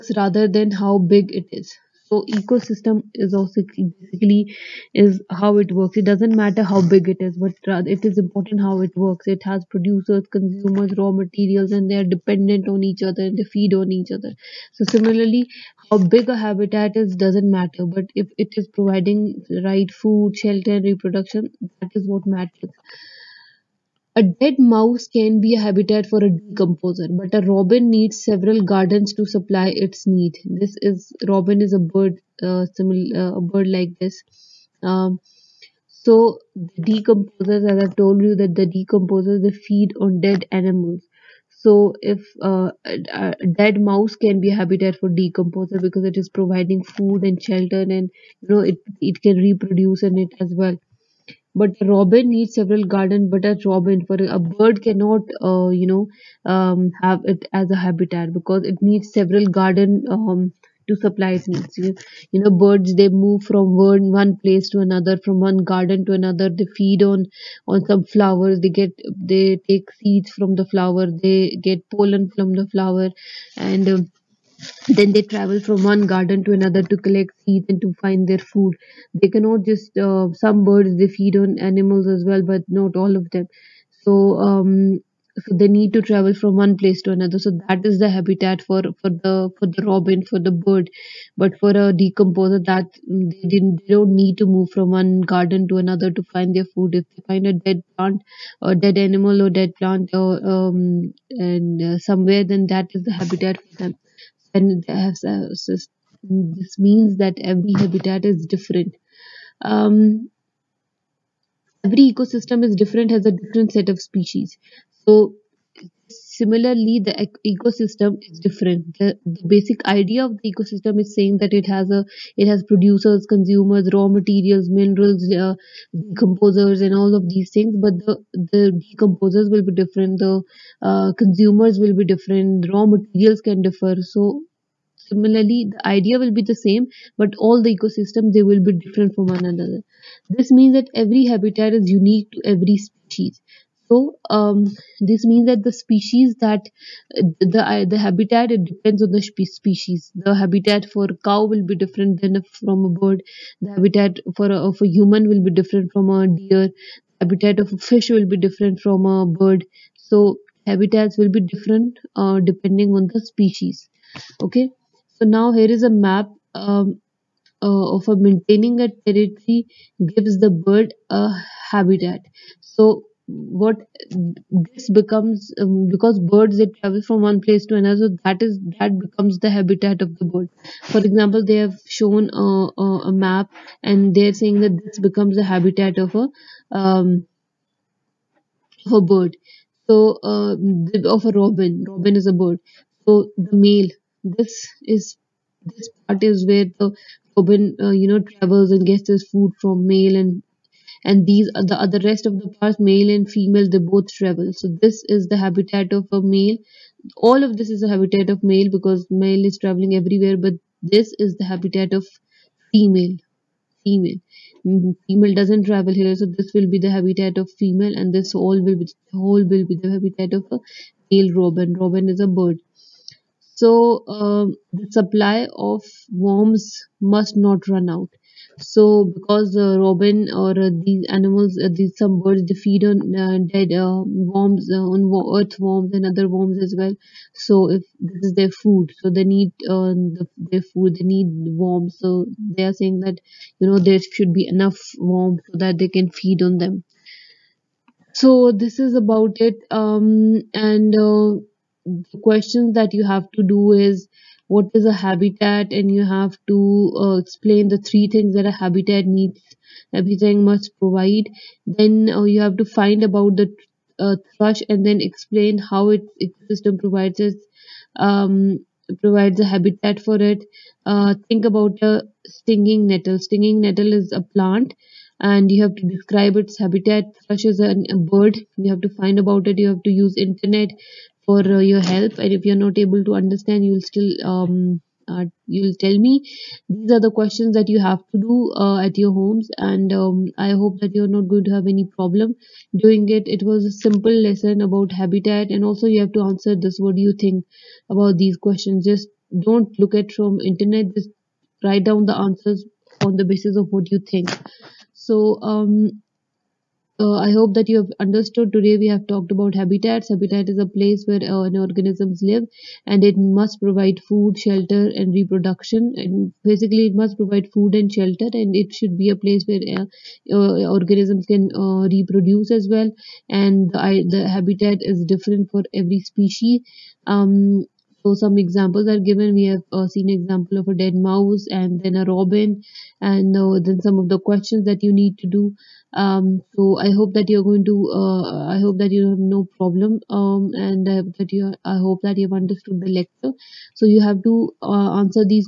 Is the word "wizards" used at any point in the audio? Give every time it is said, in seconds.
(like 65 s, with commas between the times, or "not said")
not said.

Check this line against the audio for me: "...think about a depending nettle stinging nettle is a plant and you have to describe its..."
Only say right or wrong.
wrong.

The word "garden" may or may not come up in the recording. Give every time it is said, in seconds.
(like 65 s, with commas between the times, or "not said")
28 s, 52 s, 59 s, 65 s, 76 s, 95 s.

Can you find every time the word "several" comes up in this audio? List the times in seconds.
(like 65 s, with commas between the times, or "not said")
28 s, 52 s, 59 s.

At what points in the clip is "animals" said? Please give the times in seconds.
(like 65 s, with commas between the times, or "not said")
40 s, 81 s, 98 s, 231 s.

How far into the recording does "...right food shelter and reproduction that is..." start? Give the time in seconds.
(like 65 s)
19 s.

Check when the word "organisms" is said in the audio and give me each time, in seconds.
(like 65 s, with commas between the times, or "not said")
311 s, 320 s.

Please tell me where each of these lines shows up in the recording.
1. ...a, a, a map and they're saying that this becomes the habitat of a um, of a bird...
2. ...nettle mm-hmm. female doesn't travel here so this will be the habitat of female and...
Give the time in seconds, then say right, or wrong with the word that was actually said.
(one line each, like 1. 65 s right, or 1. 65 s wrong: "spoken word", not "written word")
1. 182 s right
2. 213 s wrong: "female", not "nettle".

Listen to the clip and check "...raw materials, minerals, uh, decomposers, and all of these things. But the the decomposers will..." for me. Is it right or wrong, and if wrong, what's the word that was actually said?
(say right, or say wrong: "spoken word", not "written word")
right.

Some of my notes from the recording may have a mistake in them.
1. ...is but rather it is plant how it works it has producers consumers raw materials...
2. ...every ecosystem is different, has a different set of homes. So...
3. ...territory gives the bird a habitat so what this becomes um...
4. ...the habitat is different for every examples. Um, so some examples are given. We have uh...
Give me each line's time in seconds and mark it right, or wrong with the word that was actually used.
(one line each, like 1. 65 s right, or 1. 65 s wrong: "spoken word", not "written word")
1. 7 s wrong: "important", not "plant"
2. 111 s wrong: "species", not "homes"
3. 169 s right
4. 324 s wrong: "species", not "examples".